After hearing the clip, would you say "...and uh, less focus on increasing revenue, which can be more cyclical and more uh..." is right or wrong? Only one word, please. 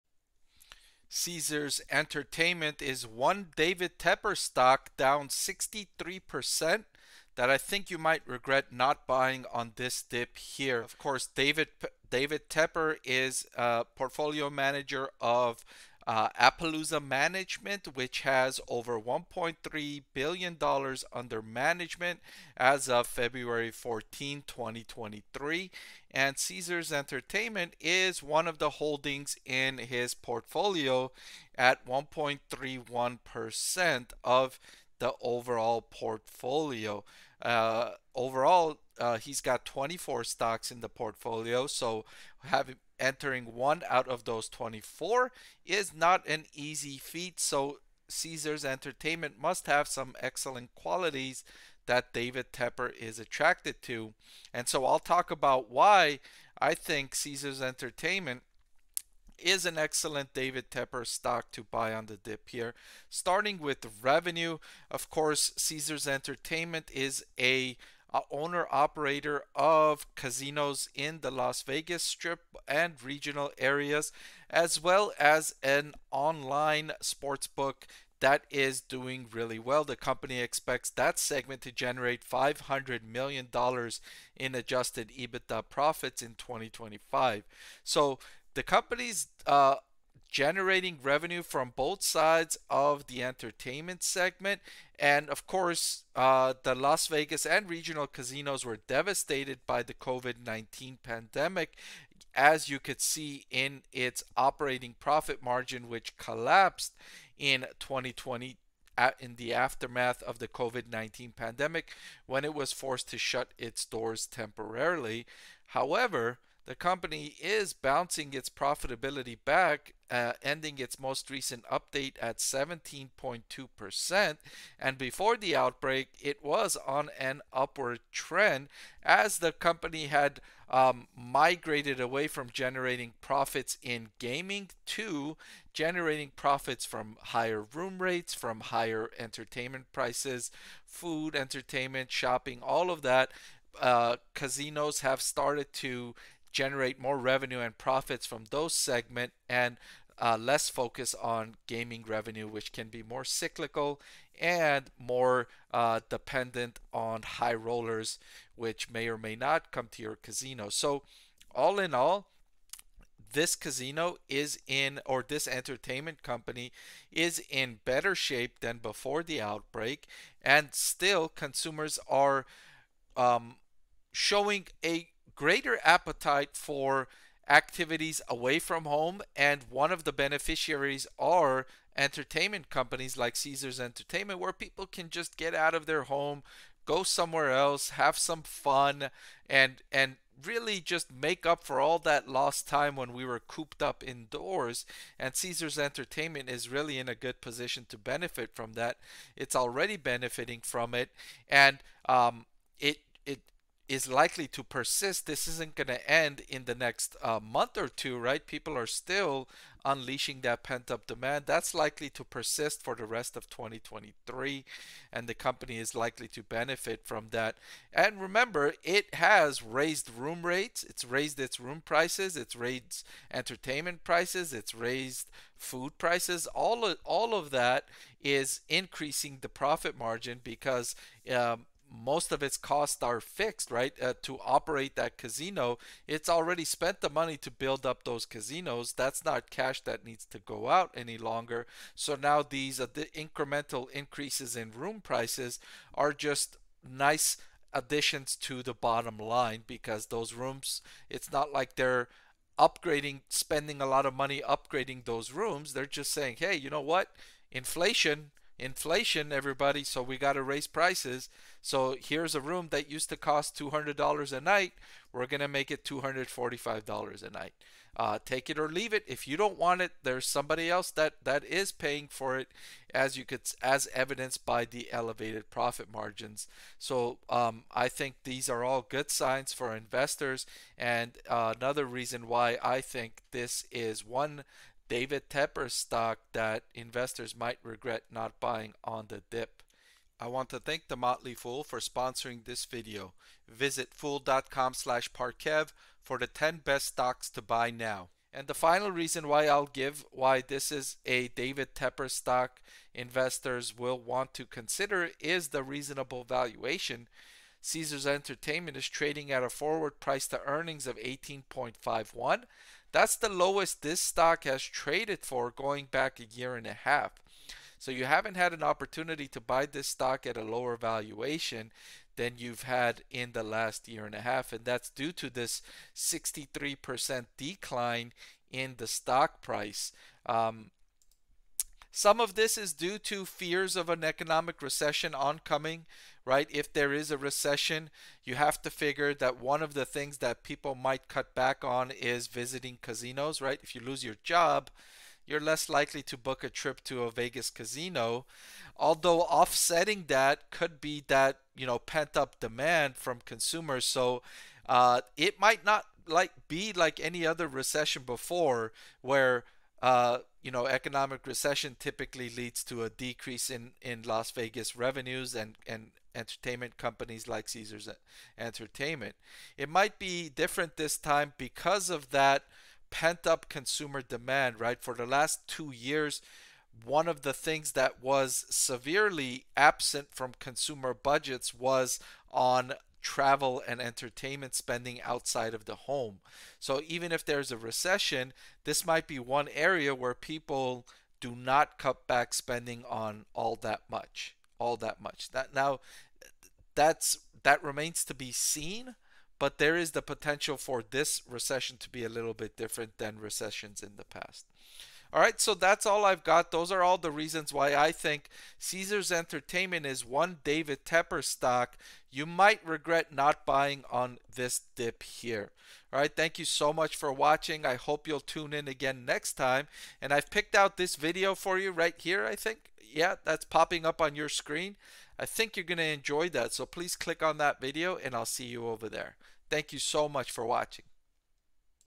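wrong.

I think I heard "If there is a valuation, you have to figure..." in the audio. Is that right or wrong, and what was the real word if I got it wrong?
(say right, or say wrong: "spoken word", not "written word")
wrong: "recession", not "valuation".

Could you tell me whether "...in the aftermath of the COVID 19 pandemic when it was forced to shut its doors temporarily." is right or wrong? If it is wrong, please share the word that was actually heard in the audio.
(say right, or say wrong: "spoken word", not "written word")
right.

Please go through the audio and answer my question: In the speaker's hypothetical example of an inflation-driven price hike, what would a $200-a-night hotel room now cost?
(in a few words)
$245.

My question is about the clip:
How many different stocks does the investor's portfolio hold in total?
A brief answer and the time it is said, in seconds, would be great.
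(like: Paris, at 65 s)
24, at 39 s.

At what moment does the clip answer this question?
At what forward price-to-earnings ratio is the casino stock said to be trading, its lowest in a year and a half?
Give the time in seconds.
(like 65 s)
310 s.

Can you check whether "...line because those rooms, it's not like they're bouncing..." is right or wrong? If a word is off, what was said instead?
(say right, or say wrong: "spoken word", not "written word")
wrong: "upgrading", not "bouncing".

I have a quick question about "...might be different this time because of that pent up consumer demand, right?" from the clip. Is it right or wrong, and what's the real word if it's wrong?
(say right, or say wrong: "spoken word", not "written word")
right.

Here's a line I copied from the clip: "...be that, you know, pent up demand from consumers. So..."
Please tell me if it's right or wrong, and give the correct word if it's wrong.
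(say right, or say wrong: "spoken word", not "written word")
right.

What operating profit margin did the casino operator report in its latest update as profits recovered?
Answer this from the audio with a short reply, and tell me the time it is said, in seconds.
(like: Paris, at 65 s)
17.2%, at 122 s.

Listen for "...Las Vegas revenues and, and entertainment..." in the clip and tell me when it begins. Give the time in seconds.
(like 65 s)
364 s.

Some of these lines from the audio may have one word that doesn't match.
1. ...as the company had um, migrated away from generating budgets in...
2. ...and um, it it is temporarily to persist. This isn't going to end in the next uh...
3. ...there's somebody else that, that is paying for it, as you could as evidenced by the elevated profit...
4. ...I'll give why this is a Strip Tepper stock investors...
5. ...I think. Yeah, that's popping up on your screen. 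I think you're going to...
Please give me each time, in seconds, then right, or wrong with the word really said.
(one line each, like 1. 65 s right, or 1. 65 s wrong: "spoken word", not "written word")
1. 129 s wrong: "profits", not "budgets"
2. 201 s wrong: "likely", not "temporarily"
3. 270 s right
4. 299 s wrong: "David", not "Strip"
5. 422 s right.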